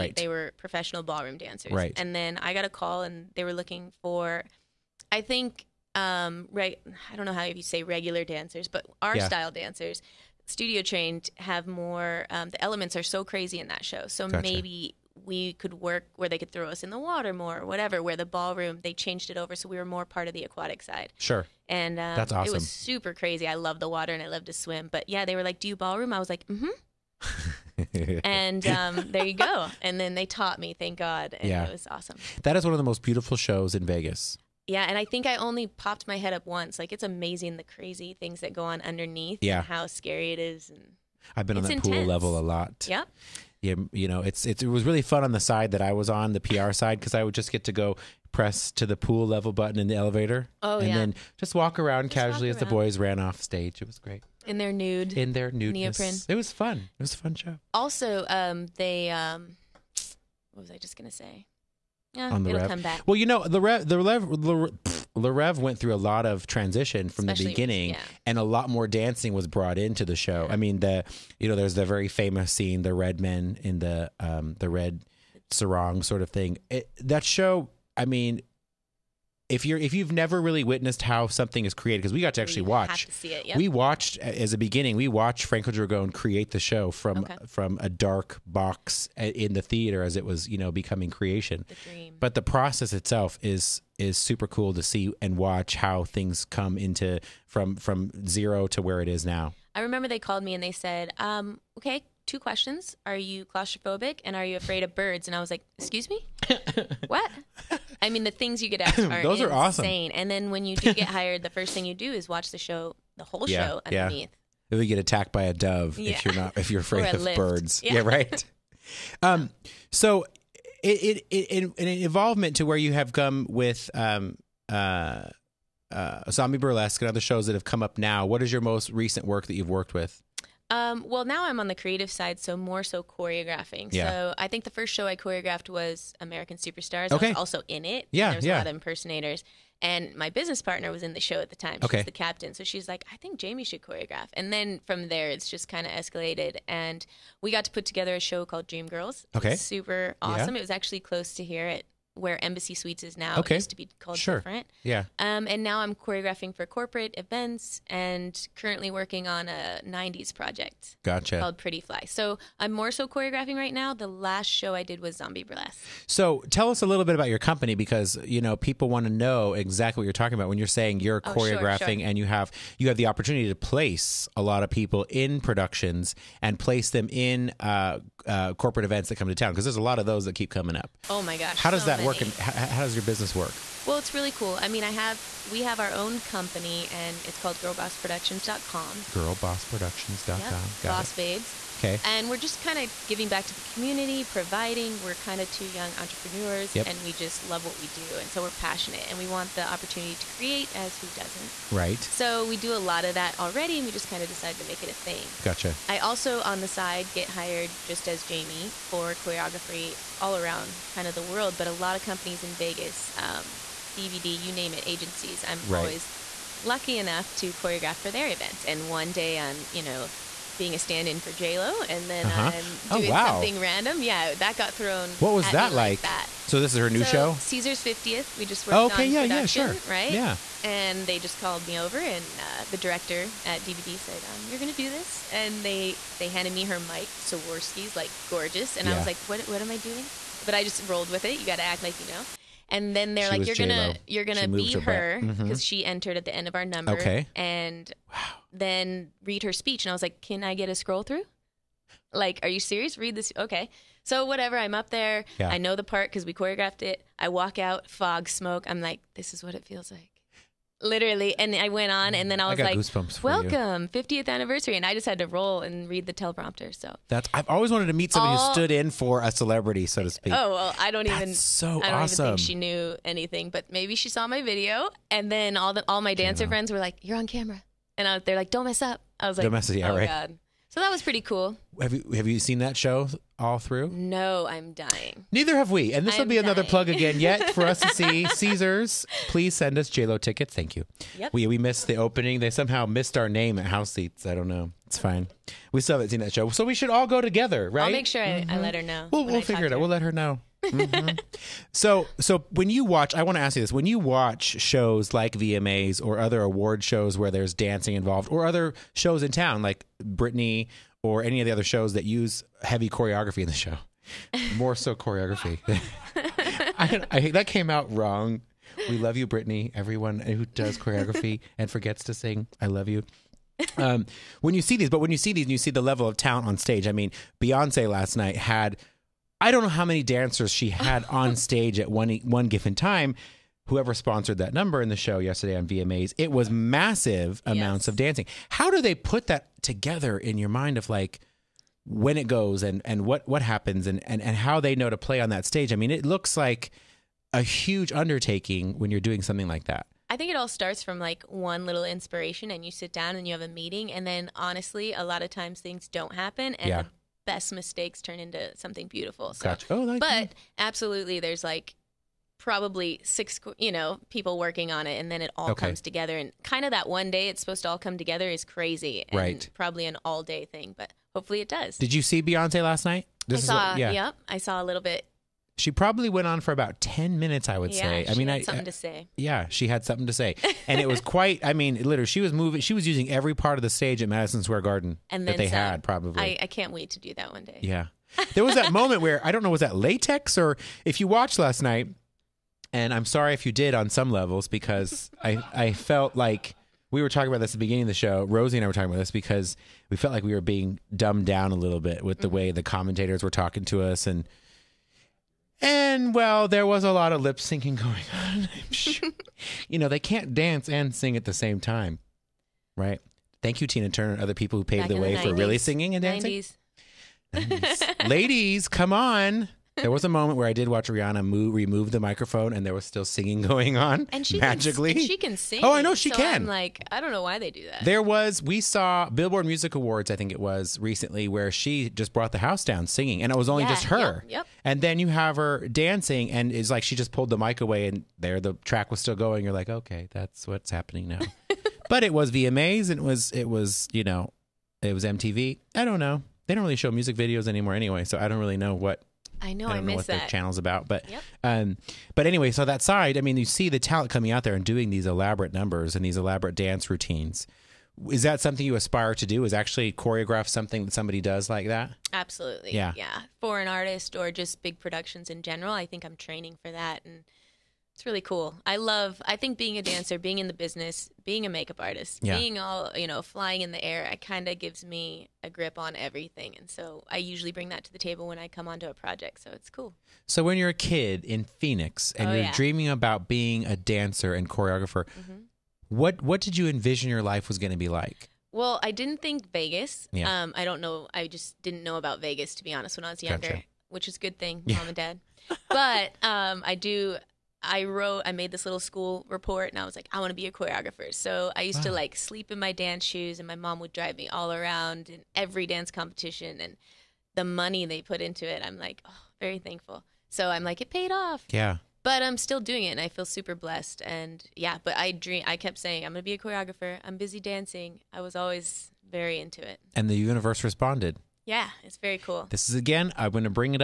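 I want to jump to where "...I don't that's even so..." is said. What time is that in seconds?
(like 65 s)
270 s.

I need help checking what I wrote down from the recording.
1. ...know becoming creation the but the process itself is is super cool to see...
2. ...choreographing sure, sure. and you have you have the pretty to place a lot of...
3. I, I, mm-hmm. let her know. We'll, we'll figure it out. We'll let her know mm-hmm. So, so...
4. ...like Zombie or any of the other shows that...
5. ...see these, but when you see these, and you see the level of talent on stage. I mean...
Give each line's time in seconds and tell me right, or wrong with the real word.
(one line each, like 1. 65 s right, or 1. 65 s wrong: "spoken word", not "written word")
1. 90 s right
2. 171 s wrong: "opportunity", not "pretty"
3. 298 s right
4. 309 s wrong: "Britney", not "Zombie"
5. 324 s right.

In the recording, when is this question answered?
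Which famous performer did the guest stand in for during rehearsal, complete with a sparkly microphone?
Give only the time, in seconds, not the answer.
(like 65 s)
221 s.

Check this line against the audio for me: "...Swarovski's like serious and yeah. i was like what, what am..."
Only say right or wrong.
wrong.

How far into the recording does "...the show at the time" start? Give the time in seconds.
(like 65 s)
141 s.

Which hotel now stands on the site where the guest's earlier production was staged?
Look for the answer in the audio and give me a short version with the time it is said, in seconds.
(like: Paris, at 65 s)
Embassy Suites, at 152 s.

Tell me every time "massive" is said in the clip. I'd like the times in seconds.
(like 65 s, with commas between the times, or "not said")
336 s.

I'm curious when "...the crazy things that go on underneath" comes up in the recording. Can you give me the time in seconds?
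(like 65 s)
37 s.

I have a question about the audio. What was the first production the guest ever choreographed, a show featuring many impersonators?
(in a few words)
American Superstars.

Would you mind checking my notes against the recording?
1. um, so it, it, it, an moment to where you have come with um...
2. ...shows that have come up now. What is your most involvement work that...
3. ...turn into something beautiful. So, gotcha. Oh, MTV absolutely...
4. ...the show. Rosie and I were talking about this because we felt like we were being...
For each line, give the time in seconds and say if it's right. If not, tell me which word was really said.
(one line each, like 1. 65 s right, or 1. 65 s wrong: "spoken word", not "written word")
1. 119 s wrong: "involvement", not "moment"
2. 127 s wrong: "recent", not "involvement"
3. 358 s wrong: "But", not "MTV"
4. 397 s right.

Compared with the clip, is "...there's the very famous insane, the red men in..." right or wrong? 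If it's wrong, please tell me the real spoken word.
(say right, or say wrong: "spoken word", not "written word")
wrong: "scene", not "insane".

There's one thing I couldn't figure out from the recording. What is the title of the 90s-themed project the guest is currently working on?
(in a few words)
Pretty Fly.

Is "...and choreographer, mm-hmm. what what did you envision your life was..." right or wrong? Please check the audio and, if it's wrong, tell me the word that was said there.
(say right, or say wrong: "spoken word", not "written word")
right.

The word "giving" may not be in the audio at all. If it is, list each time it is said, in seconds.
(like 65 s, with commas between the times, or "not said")
193 s.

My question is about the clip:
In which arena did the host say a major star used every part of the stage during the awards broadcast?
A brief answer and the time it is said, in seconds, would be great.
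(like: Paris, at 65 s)
Madison Square Garden, at 384 s.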